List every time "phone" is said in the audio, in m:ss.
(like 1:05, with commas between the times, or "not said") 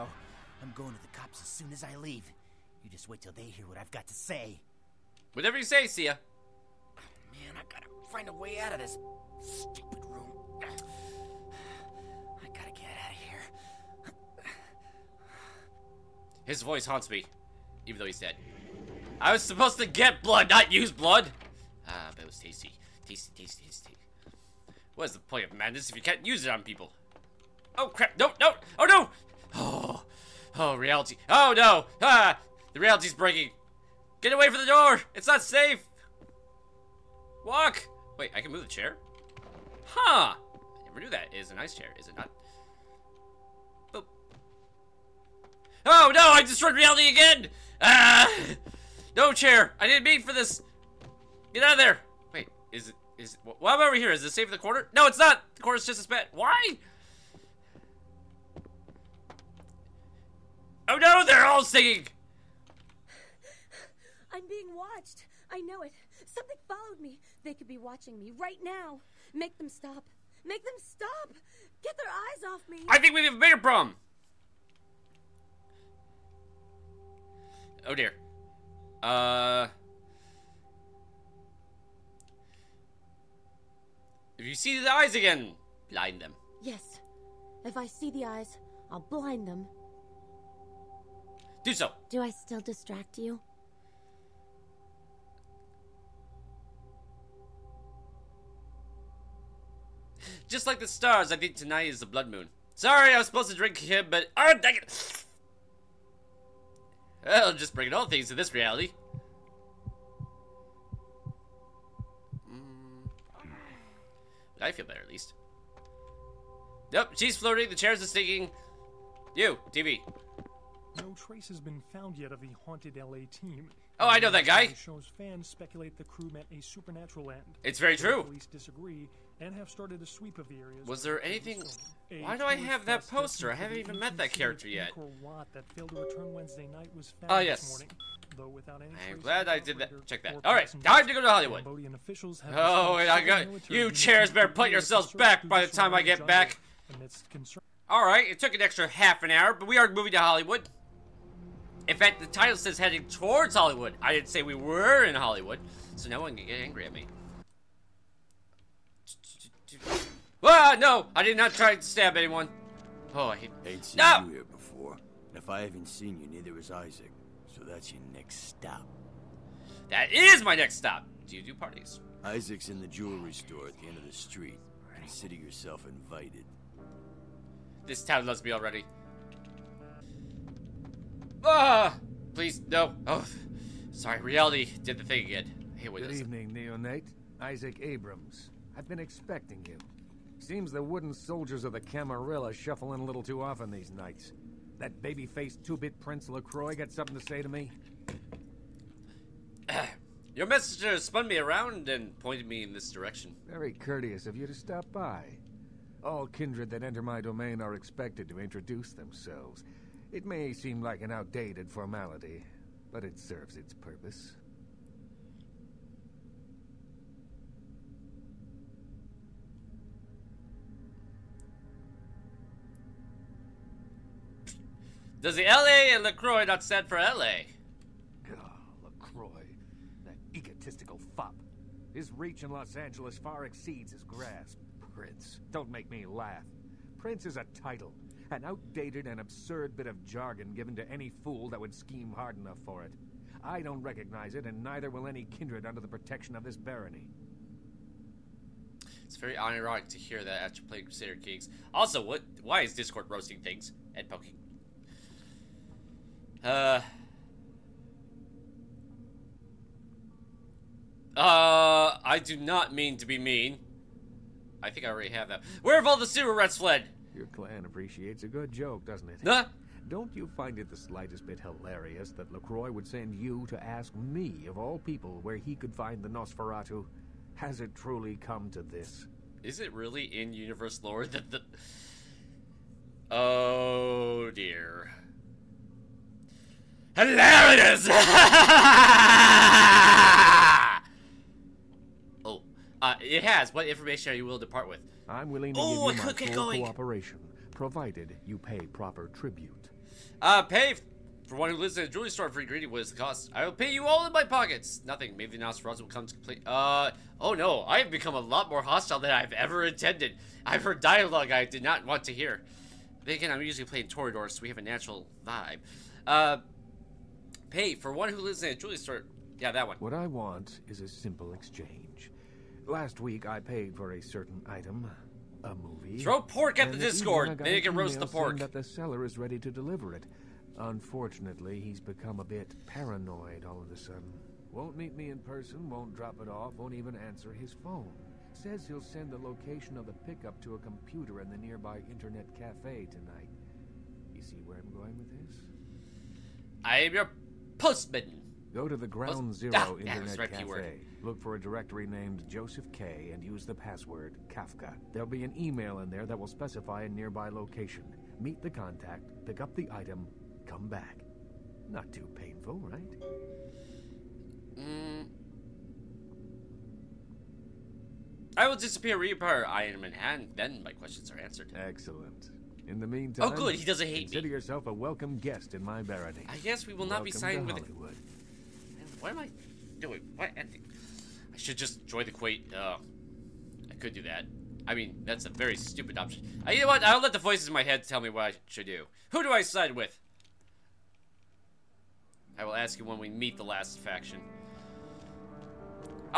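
5:37.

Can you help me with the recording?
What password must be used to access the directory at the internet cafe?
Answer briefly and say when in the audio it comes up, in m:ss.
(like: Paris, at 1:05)
Kafka, at 5:54.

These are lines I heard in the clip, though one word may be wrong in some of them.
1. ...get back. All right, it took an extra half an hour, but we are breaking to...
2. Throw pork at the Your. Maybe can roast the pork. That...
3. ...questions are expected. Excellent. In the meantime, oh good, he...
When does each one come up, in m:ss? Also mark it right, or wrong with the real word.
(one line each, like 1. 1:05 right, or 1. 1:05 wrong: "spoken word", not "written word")
1. 2:26 wrong: "moving", not "breaking"
2. 5:25 wrong: "Discord", not "Your"
3. 6:10 wrong: "answered", not "expected".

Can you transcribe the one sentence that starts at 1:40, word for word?
Just like the stars, I think tonight is the blood moon.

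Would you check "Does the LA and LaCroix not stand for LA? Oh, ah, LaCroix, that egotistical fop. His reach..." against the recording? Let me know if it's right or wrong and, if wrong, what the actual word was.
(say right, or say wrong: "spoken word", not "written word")
right.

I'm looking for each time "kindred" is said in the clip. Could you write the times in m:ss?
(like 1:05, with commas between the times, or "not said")
3:26, 4:05.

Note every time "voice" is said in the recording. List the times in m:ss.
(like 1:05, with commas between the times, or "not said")
0:16, 6:27.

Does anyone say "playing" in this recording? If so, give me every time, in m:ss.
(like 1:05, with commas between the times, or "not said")
4:10, 5:13.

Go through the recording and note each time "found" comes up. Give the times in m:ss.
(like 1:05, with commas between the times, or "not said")
2:01, 2:17.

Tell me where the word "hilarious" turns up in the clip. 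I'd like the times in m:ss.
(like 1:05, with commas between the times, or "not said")
4:31, 4:46.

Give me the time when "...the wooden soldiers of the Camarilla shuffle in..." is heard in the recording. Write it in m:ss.
3:10.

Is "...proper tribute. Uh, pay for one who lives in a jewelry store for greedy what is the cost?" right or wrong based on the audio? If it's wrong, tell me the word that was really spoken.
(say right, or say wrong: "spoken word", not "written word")
right.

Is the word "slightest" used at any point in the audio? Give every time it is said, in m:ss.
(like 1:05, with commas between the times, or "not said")
4:30.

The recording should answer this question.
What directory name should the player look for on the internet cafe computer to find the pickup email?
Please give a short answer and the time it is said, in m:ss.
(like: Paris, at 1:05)
Joseph K, at 5:52.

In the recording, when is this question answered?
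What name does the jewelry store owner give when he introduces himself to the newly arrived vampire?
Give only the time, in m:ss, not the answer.
3:07.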